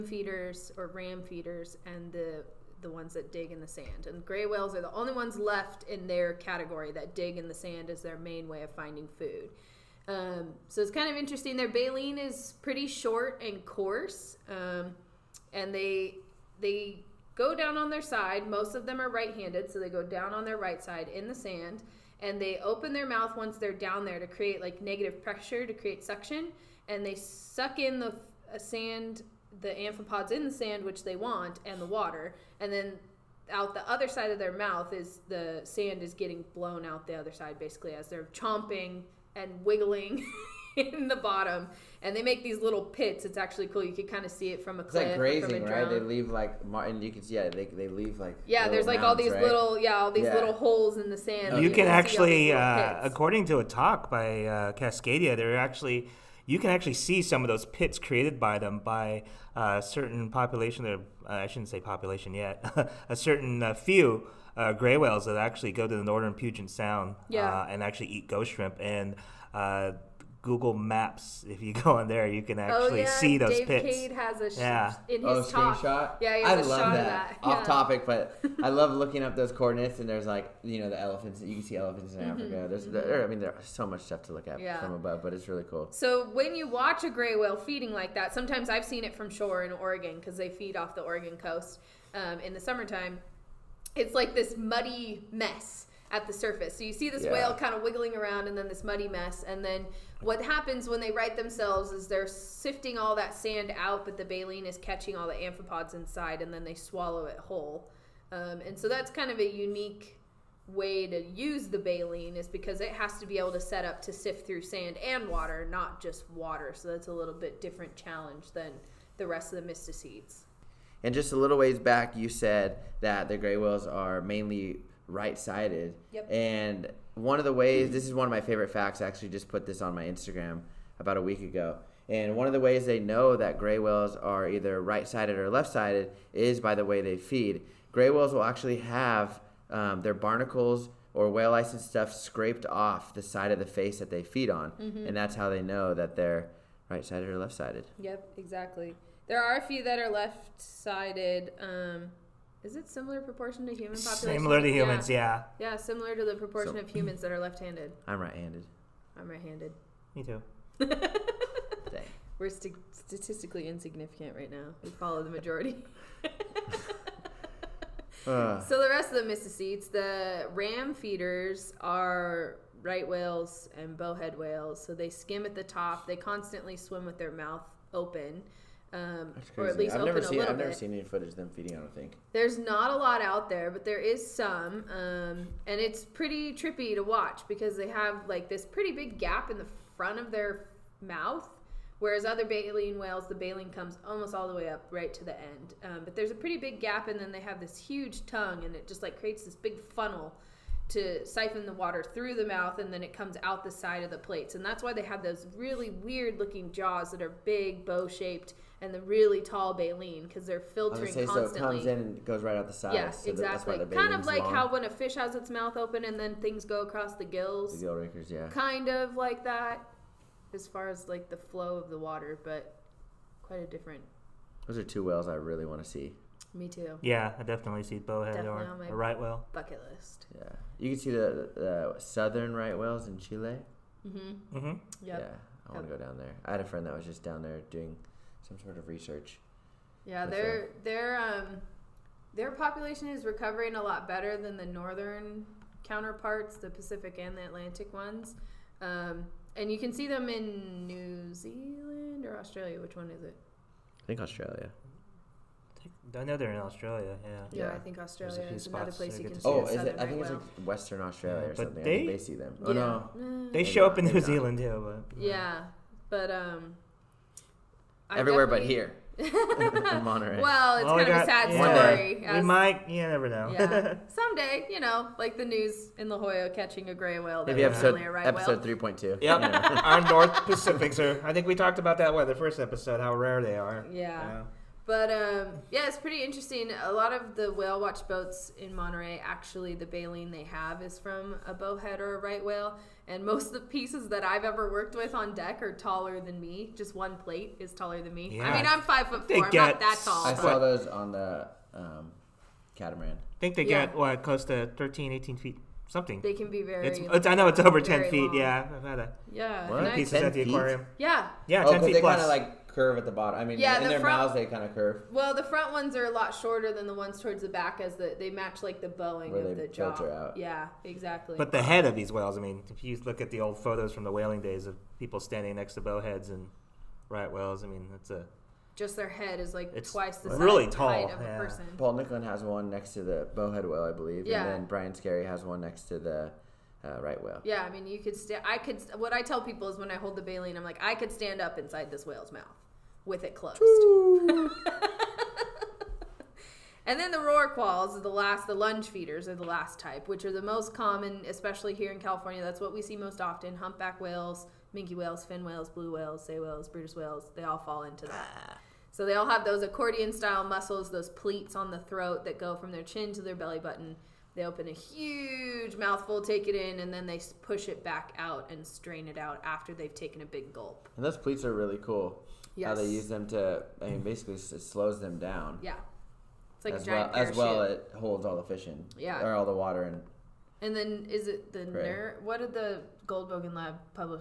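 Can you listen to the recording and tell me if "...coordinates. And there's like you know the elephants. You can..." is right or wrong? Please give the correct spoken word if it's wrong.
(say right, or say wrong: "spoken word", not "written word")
right.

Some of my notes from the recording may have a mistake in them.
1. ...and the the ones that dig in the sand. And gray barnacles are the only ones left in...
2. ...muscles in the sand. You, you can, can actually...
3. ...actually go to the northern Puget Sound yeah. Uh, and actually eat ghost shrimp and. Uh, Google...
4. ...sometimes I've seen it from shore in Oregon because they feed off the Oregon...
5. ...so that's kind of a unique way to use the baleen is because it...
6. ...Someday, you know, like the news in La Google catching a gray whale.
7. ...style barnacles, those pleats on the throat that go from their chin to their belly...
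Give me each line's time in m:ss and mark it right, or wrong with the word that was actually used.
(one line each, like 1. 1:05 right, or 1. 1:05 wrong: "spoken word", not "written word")
1. 0:01 wrong: "whales", not "barnacles"
2. 0:50 wrong: "holes", not "muscles"
3. 1:05 right
4. 1:28 right
5. 1:48 right
6. 4:34 wrong: "Jolla", not "Google"
7. 6:00 wrong: "muscles", not "barnacles".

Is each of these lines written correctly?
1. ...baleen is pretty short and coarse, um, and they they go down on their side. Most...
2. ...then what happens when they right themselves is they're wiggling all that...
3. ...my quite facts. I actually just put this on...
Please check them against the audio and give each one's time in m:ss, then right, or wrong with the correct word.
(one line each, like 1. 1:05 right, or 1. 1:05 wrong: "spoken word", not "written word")
1. 0:11 right
2. 1:39 wrong: "sifting", not "wiggling"
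3. 2:08 wrong: "favorite", not "quite".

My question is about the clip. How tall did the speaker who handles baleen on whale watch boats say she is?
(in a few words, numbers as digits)
5 foot 4.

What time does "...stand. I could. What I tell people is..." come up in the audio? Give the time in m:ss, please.
5:38.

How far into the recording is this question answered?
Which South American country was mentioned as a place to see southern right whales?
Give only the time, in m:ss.
3:53.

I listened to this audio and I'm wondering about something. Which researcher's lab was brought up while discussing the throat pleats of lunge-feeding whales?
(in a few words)
Goldbogen Lab.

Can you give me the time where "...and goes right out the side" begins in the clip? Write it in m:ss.
3:31.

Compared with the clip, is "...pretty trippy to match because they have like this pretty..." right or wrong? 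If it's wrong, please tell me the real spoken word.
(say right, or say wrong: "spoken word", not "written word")
wrong: "watch", not "match".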